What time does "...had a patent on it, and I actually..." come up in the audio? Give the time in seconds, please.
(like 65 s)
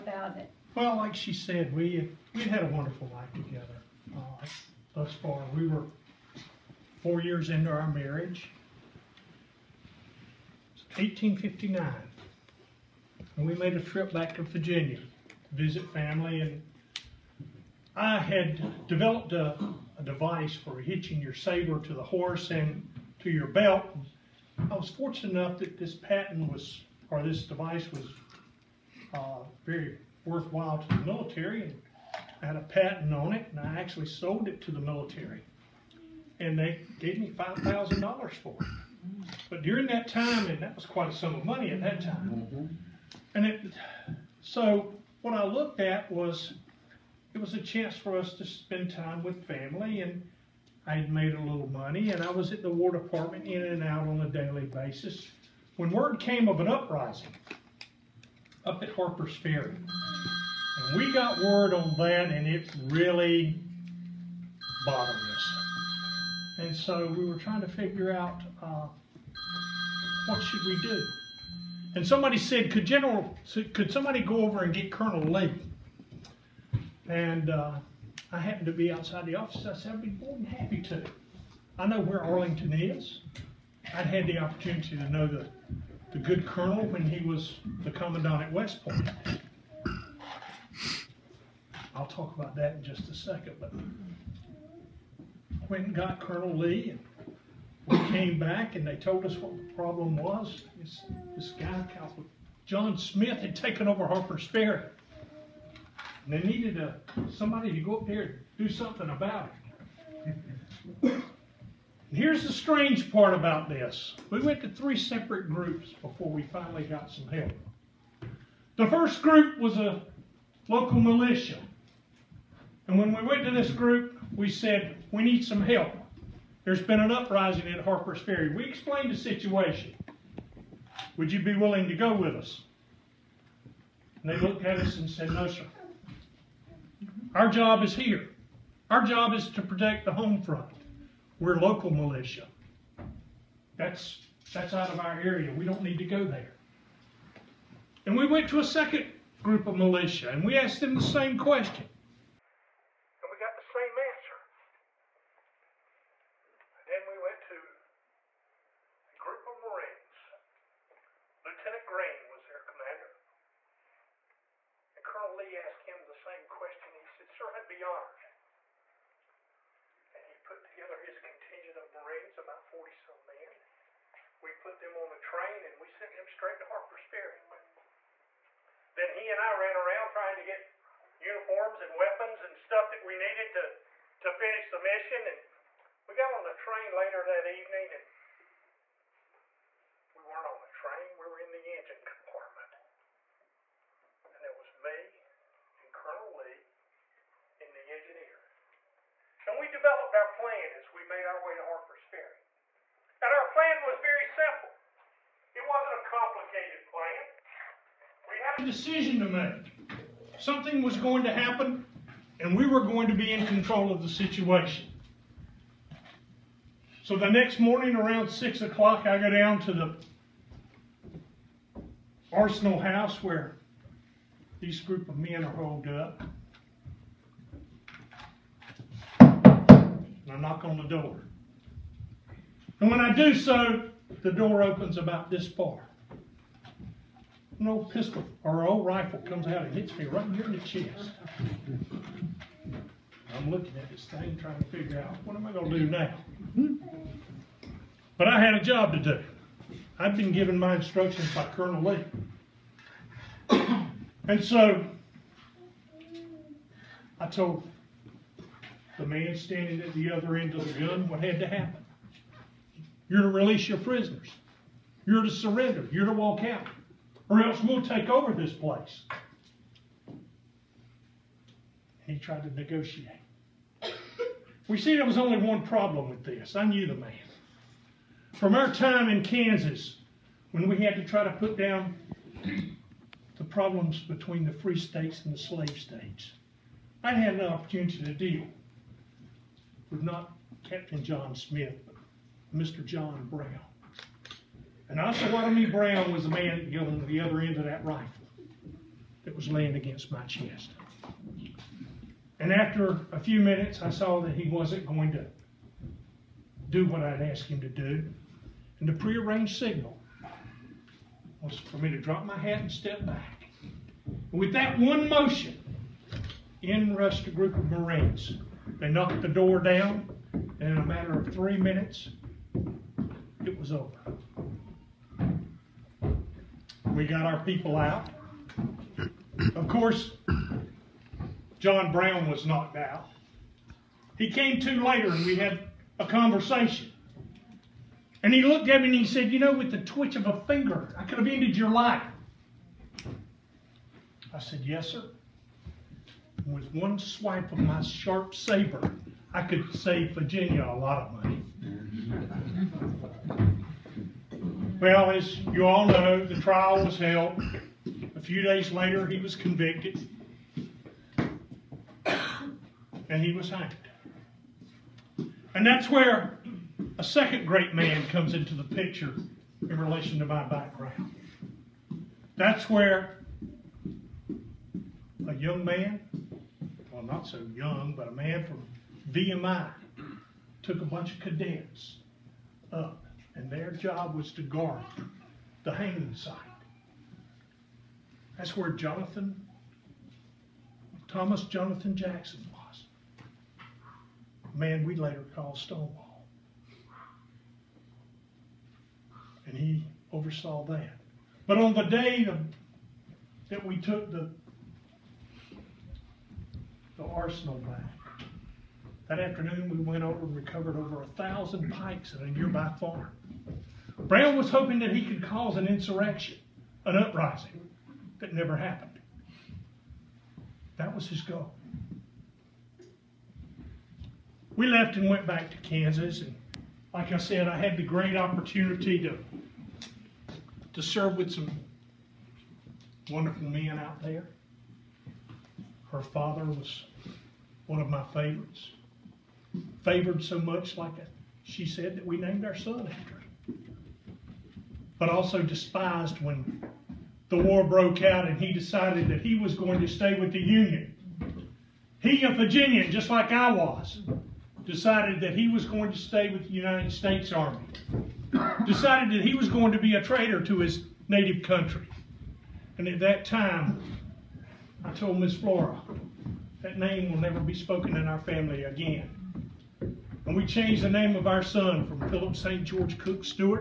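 32 s.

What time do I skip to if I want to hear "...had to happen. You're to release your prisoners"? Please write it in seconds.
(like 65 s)
261 s.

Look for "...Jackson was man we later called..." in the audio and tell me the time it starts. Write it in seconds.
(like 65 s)
391 s.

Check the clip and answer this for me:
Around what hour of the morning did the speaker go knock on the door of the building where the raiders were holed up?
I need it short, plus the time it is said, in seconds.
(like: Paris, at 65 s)
6 o'clock, at 218 s.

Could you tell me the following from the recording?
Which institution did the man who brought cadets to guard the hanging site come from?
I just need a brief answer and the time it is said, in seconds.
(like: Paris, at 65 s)
VMI, at 379 s.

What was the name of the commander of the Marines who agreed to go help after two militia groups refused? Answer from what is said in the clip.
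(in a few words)
Lieutenant Greene.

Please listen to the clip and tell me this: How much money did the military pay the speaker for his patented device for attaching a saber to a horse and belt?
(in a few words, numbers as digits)
$5,000.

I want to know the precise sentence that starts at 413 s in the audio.
Brown was hoping that he could cause an insurrection, an uprising that never happened.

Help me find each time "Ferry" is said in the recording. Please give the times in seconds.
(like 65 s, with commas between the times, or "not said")
59 s, 104 s, 128 s, 177 s, 202 s.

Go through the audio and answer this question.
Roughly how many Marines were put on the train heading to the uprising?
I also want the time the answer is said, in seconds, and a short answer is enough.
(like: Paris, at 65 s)
40 some, at 172 s.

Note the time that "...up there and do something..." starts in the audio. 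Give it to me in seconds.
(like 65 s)
107 s.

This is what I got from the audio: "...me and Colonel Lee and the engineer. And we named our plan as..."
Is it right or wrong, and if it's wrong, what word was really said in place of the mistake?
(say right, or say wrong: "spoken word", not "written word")
wrong: "developed", not "named".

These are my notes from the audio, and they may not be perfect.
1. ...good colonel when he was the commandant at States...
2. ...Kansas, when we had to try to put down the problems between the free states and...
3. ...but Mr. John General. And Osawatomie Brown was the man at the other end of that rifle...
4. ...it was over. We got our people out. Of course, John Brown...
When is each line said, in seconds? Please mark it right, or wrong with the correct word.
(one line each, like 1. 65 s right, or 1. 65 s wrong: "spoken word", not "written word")
1. 86 s wrong: "West", not "States"
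2. 279 s right
3. 291 s wrong: "Brown", not "General"
4. 323 s right.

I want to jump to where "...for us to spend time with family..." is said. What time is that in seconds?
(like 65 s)
47 s.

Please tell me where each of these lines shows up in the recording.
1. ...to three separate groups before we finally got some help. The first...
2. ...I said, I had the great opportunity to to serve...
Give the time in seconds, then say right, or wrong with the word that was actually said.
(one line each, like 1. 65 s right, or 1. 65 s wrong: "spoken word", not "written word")
1. 114 s right
2. 427 s right.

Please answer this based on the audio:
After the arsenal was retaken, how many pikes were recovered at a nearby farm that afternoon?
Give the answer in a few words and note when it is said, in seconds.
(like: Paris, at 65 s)
Over 1,000, at 410 s.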